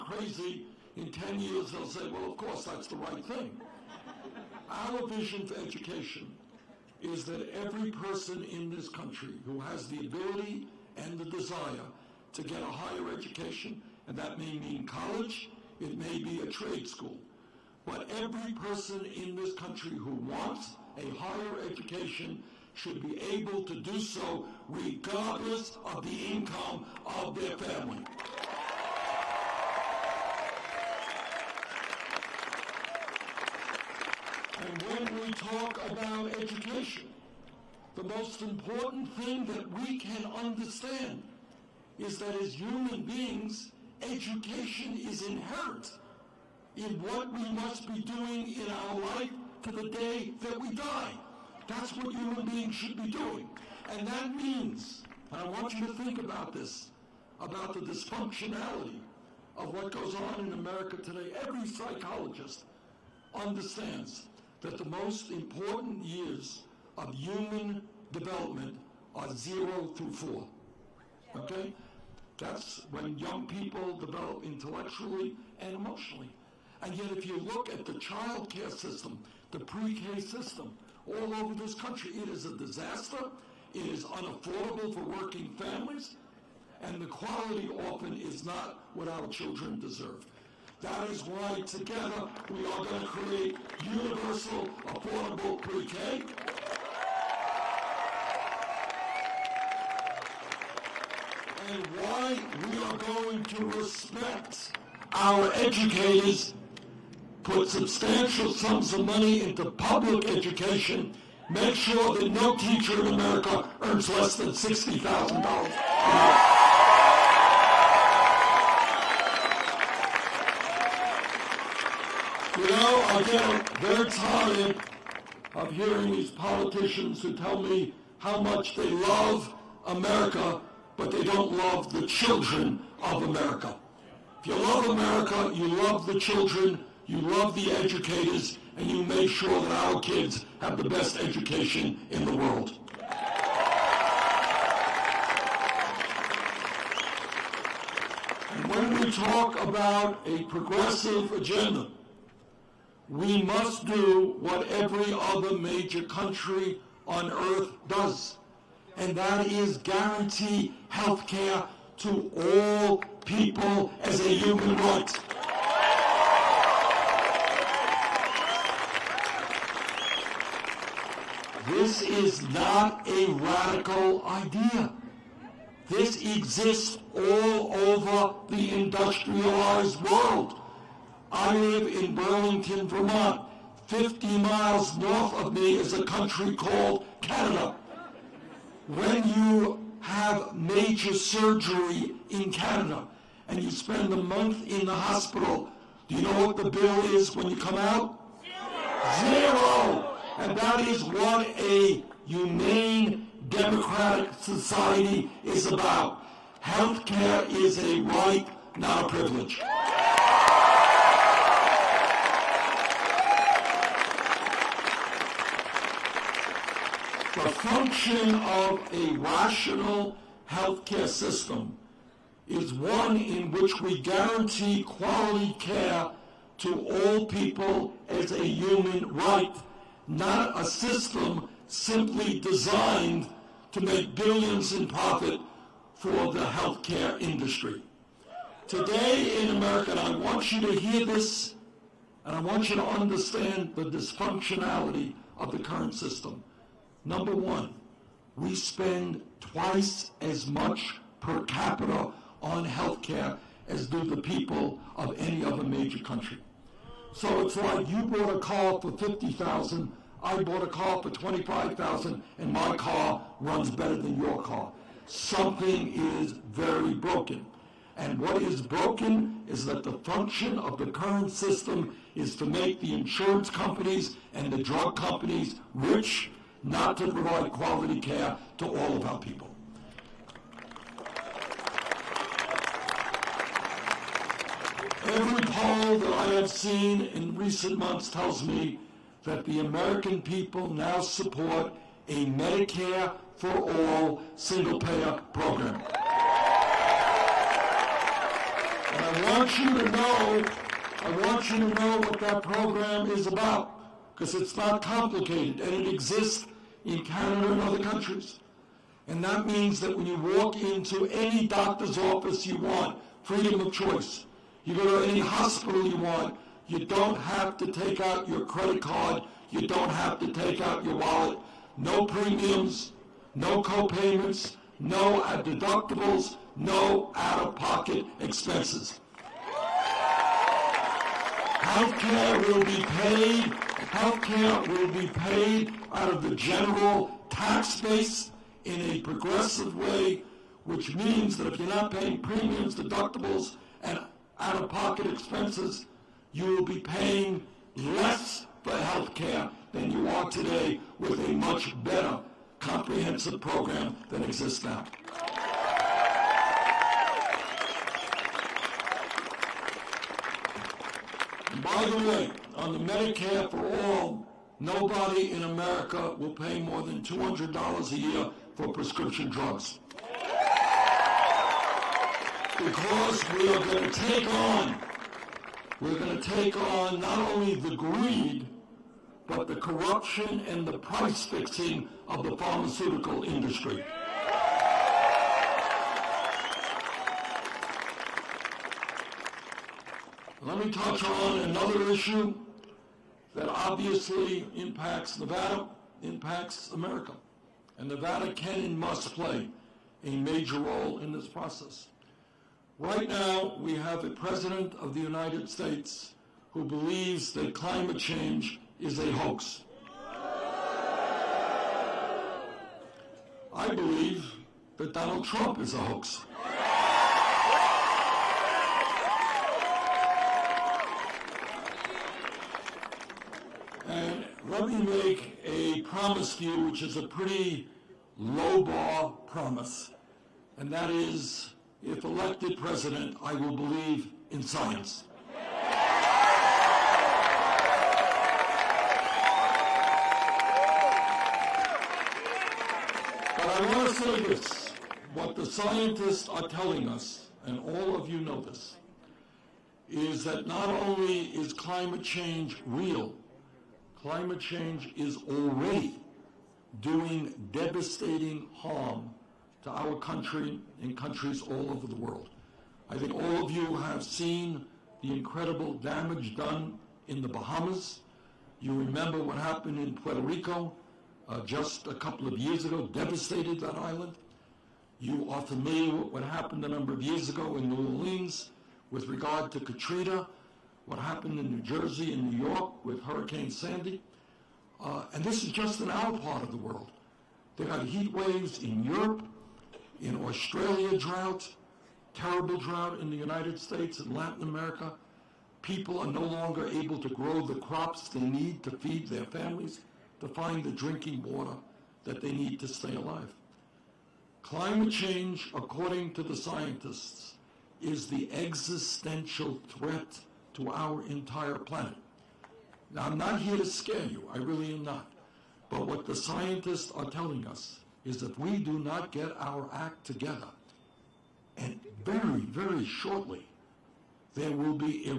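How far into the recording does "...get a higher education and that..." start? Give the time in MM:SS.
00:12.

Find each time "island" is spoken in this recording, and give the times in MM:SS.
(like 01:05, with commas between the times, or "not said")
07:53.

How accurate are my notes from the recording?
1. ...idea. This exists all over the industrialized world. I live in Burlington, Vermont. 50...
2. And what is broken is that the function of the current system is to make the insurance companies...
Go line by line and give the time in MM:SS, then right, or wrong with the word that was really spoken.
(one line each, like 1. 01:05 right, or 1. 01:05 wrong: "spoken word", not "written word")
1. 02:54 right
2. 04:27 right.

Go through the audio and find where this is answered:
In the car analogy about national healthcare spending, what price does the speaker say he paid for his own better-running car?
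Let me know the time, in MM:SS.
04:21.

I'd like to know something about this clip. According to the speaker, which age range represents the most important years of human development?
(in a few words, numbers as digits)
zero through four.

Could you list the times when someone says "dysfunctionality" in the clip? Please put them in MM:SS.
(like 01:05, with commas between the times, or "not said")
00:57, 04:03.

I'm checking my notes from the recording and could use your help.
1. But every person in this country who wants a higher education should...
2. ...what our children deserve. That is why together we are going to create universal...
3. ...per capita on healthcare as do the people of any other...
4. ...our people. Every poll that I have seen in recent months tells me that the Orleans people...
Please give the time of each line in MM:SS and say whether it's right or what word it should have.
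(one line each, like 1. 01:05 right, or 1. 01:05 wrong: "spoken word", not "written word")
1. 00:17 right
2. 01:28 right
3. 04:11 right
4. 04:39 wrong: "American", not "Orleans".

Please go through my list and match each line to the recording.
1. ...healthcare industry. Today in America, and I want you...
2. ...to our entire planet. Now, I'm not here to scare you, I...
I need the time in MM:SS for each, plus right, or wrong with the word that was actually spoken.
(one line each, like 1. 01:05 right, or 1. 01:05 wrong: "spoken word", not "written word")
1. 03:56 right
2. 08:30 right.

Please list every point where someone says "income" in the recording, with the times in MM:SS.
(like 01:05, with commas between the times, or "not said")
00:26.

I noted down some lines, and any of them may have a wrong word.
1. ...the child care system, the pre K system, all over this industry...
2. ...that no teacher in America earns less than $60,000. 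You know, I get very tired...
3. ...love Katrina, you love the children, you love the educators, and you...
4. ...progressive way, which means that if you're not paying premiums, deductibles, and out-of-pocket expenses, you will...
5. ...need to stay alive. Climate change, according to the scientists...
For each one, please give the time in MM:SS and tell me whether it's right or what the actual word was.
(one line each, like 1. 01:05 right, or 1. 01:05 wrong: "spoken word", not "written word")
1. 01:17 wrong: "country", not "industry"
2. 01:52 right
3. 02:14 wrong: "America", not "Katrina"
4. 05:39 right
5. 08:22 right.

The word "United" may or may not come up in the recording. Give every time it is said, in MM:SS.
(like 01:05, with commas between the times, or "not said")
06:45, 08:13.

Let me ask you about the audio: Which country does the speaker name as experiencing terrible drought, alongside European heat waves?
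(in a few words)
Australia.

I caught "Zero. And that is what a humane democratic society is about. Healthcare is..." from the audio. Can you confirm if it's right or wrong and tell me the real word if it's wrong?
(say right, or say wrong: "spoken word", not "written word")
right.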